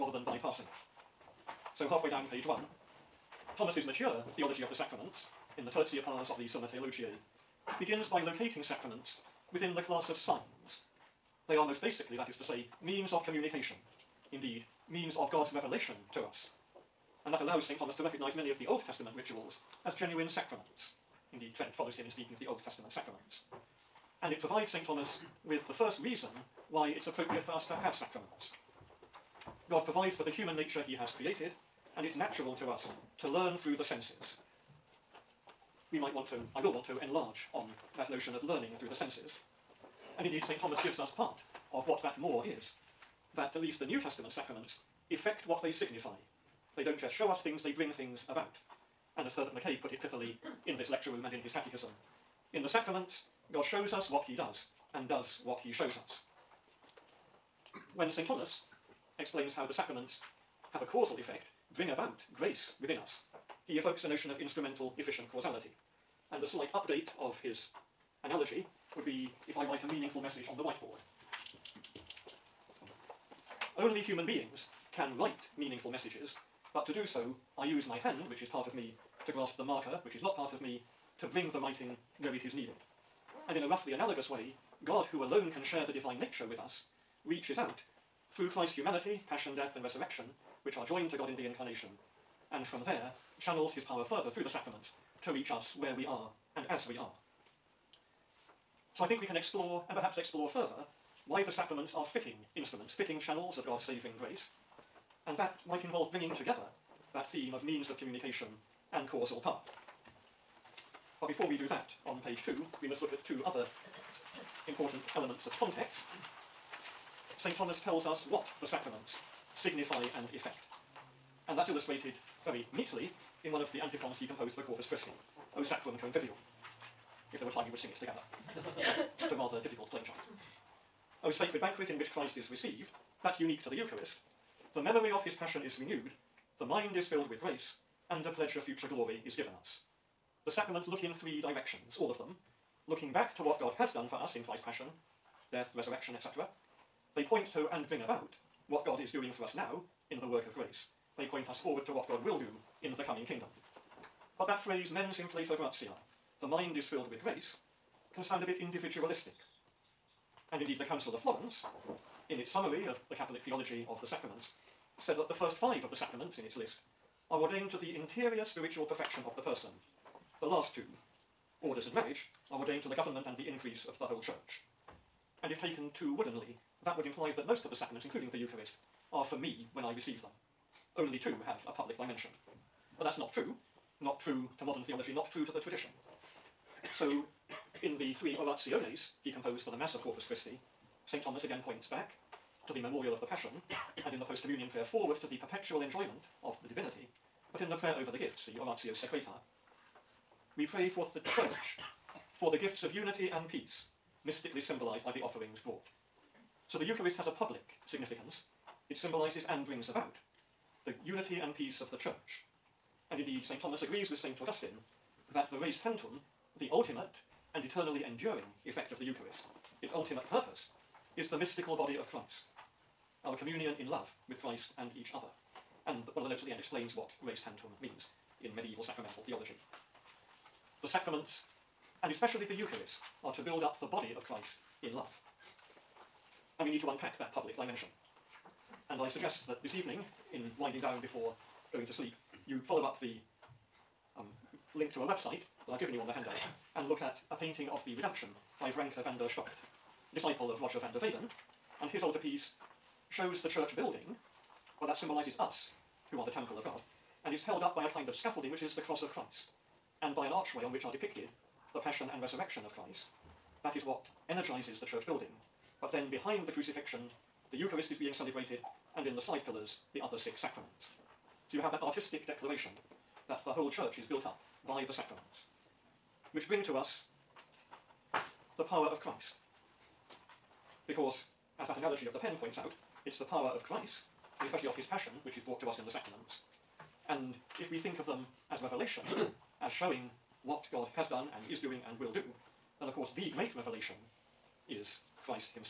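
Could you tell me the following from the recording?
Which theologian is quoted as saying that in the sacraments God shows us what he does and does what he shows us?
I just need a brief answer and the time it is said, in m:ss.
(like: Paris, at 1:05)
Herbert McCabe, at 0:49.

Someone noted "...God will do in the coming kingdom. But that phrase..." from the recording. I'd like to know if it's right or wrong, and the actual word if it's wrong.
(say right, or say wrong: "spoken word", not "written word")
right.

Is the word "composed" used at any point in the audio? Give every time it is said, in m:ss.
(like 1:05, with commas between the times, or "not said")
2:04, 3:09.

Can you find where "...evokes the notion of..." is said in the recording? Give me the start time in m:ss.
1:03.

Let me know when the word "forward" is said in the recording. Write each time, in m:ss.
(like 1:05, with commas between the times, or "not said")
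2:31, 3:14.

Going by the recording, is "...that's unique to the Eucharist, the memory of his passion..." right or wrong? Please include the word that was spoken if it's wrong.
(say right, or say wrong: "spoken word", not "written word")
right.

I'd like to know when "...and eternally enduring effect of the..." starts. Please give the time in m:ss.
3:37.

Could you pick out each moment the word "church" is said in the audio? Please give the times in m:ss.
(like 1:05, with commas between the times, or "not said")
2:54, 3:21, 3:31, 4:13, 4:24, 4:33.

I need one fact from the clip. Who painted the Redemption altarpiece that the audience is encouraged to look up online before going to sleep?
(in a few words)
Vrancke van der Stockt.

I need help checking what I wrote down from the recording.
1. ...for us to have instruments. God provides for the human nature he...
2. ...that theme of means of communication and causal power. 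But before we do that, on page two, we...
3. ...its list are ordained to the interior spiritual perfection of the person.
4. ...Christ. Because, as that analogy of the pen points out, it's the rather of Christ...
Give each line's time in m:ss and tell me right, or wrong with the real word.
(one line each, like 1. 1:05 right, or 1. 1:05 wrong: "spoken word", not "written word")
1. 0:27 wrong: "sacraments", not "instruments"
2. 1:47 right
3. 2:46 right
4. 4:39 wrong: "power", not "rather".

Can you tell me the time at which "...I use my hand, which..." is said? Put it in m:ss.
1:17.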